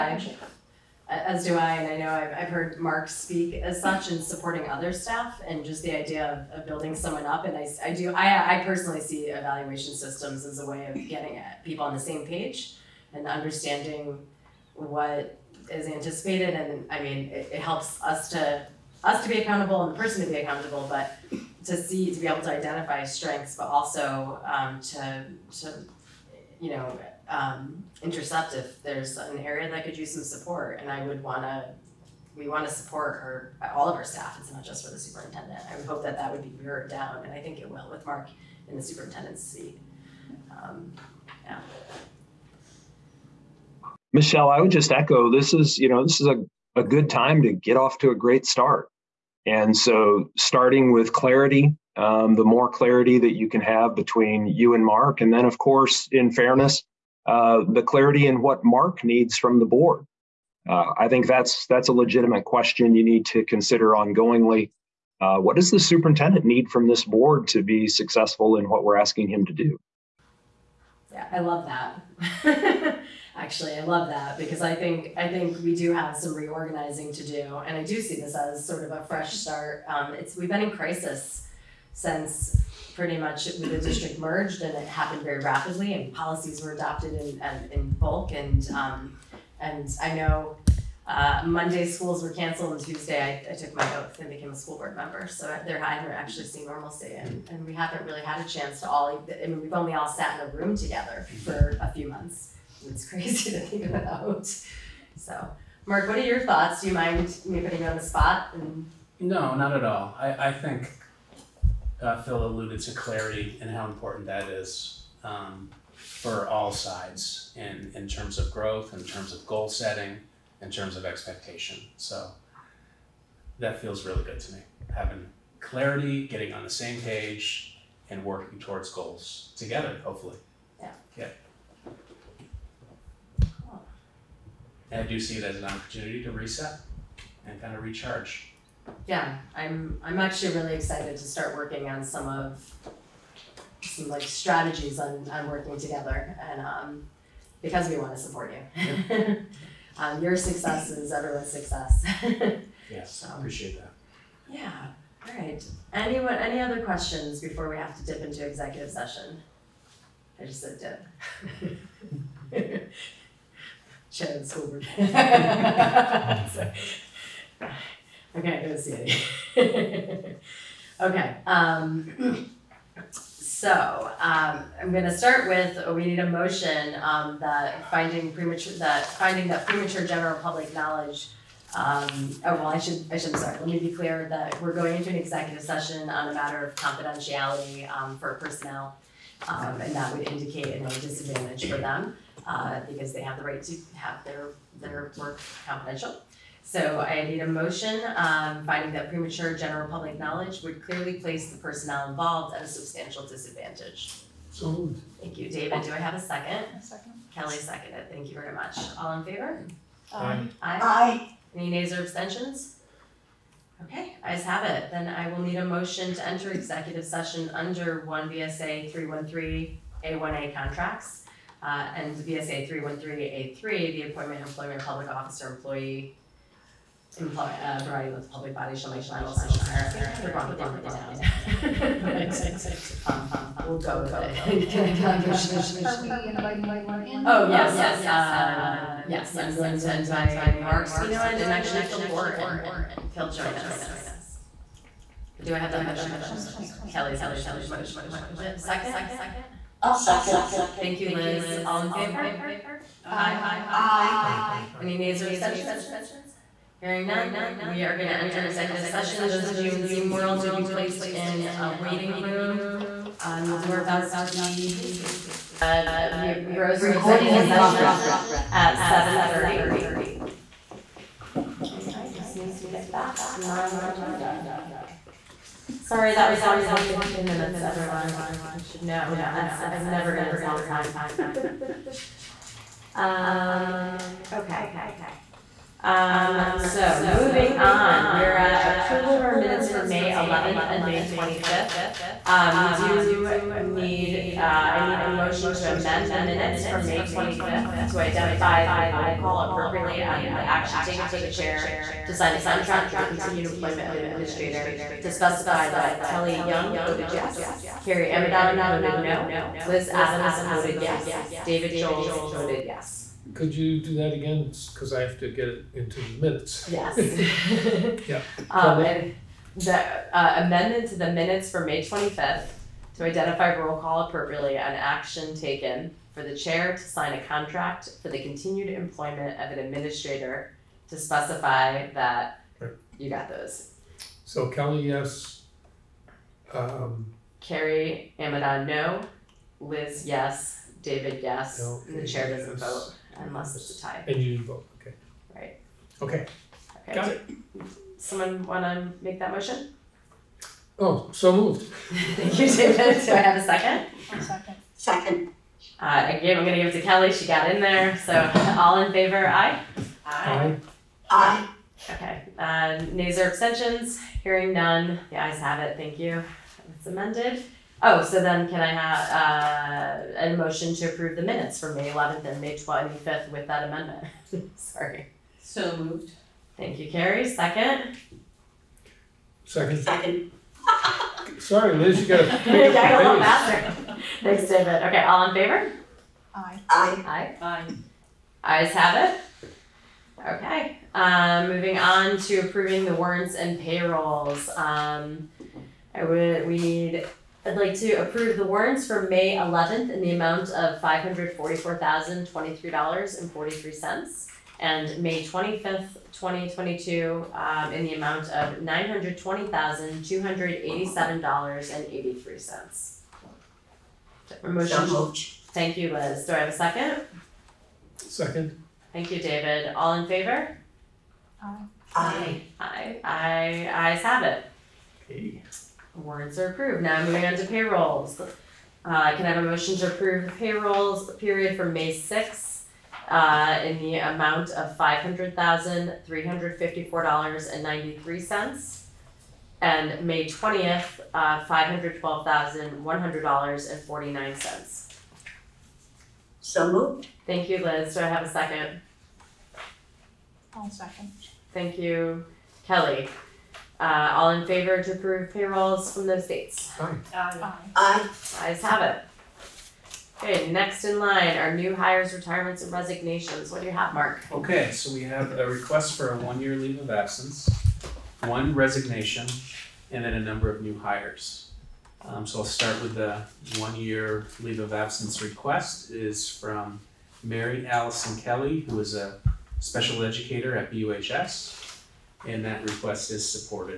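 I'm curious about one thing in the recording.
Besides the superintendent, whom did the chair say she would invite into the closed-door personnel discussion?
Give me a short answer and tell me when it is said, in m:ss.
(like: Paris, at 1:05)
Phil Gore, at 4:01.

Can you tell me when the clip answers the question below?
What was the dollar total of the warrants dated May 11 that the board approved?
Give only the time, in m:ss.
6:40.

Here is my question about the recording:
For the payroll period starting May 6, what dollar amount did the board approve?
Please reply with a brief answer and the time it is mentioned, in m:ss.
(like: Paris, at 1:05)
$500,354.93, at 7:14.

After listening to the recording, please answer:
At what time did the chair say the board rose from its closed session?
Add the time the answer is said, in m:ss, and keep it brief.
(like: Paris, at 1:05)
7:30, at 4:28.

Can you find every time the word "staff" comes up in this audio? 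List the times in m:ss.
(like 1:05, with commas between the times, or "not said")
0:04, 0:34.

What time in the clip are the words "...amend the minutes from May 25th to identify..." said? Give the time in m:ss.
4:55.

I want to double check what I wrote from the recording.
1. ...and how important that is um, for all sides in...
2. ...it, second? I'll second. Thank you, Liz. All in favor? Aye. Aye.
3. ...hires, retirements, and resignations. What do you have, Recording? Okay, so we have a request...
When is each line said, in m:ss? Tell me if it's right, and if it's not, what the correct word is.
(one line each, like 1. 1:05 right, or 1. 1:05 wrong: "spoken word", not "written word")
1. 1:53 right
2. 4:08 right
3. 7:41 wrong: "Mark", not "Recording".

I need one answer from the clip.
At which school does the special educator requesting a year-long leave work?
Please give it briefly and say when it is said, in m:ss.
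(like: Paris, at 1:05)
BUHS, at 8:00.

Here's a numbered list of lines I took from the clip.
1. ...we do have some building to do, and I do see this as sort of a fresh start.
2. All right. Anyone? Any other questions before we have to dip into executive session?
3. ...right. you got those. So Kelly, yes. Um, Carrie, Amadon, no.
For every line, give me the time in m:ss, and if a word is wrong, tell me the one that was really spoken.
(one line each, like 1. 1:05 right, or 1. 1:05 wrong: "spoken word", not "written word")
1. 1:15 wrong: "reorganizing", not "building"
2. 2:35 right
3. 5:32 right.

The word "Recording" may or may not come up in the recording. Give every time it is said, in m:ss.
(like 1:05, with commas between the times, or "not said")
4:26.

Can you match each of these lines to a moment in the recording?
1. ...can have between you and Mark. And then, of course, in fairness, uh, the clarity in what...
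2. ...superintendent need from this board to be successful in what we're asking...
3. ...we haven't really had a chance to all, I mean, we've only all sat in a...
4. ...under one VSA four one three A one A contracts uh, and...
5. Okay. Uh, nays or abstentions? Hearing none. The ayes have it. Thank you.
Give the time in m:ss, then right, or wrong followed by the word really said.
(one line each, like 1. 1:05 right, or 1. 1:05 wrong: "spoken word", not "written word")
1. 0:53 right
2. 1:05 right
3. 1:37 right
4. 3:37 wrong: "three", not "four"
5. 6:01 right.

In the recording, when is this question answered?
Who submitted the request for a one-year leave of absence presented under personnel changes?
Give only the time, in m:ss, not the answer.
7:57.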